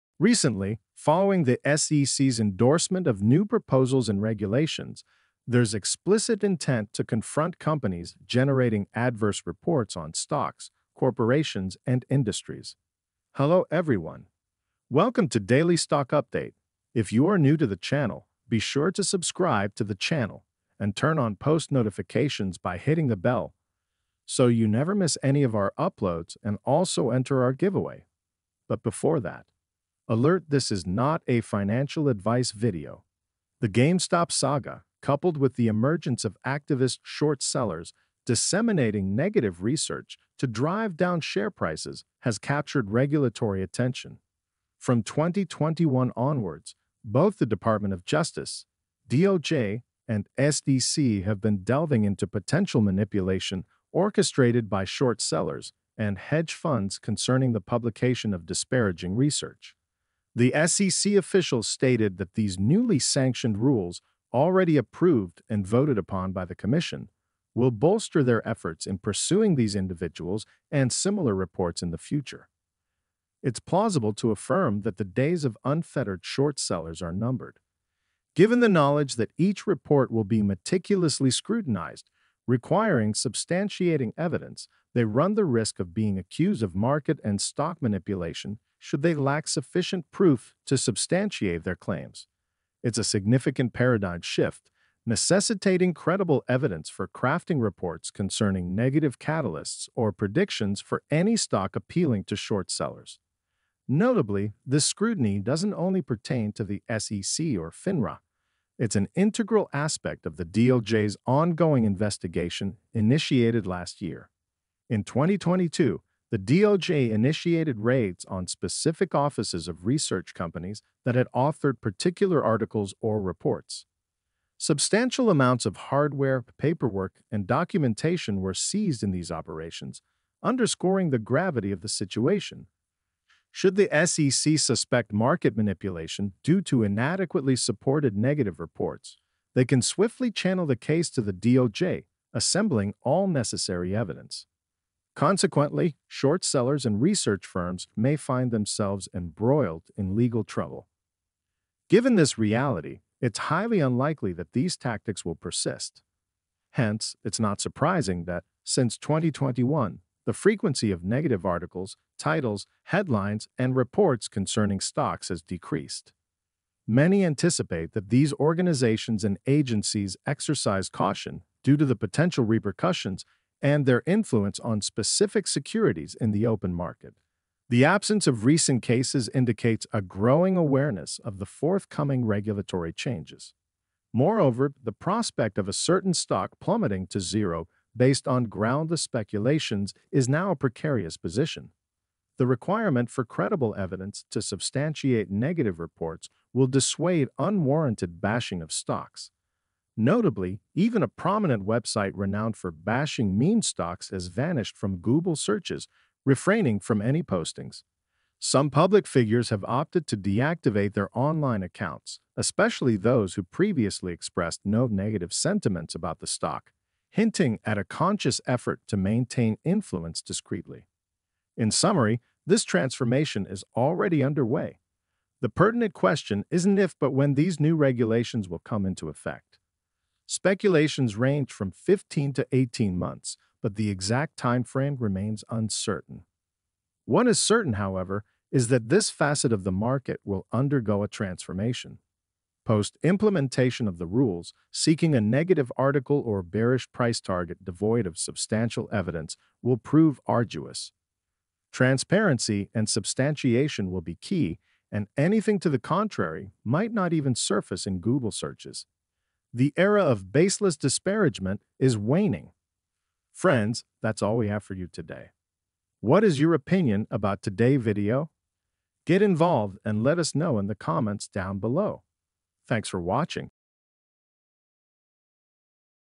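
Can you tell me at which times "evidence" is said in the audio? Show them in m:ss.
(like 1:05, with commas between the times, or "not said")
1:24, 1:36, 2:23, 3:13, 4:08.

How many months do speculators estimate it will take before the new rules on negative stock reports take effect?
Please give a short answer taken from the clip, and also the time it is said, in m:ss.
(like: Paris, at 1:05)
15 to 18 months, at 3:51.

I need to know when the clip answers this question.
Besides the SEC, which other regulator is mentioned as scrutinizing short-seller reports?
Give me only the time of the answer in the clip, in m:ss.
1:47.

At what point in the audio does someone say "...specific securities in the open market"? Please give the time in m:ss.
2:54.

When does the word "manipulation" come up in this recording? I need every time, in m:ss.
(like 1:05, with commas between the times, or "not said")
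0:52, 1:27, 2:15.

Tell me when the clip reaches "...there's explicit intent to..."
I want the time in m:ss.
0:05.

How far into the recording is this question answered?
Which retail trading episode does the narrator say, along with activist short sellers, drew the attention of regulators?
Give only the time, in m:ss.
0:33.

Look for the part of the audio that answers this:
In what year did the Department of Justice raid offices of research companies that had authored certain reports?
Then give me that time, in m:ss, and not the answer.
1:55.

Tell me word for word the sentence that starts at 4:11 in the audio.
Transparency and substantiation will be key, and anything to the contrary might not even surface in Google searches.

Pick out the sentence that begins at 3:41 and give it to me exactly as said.
In summary, this transformation is already underway.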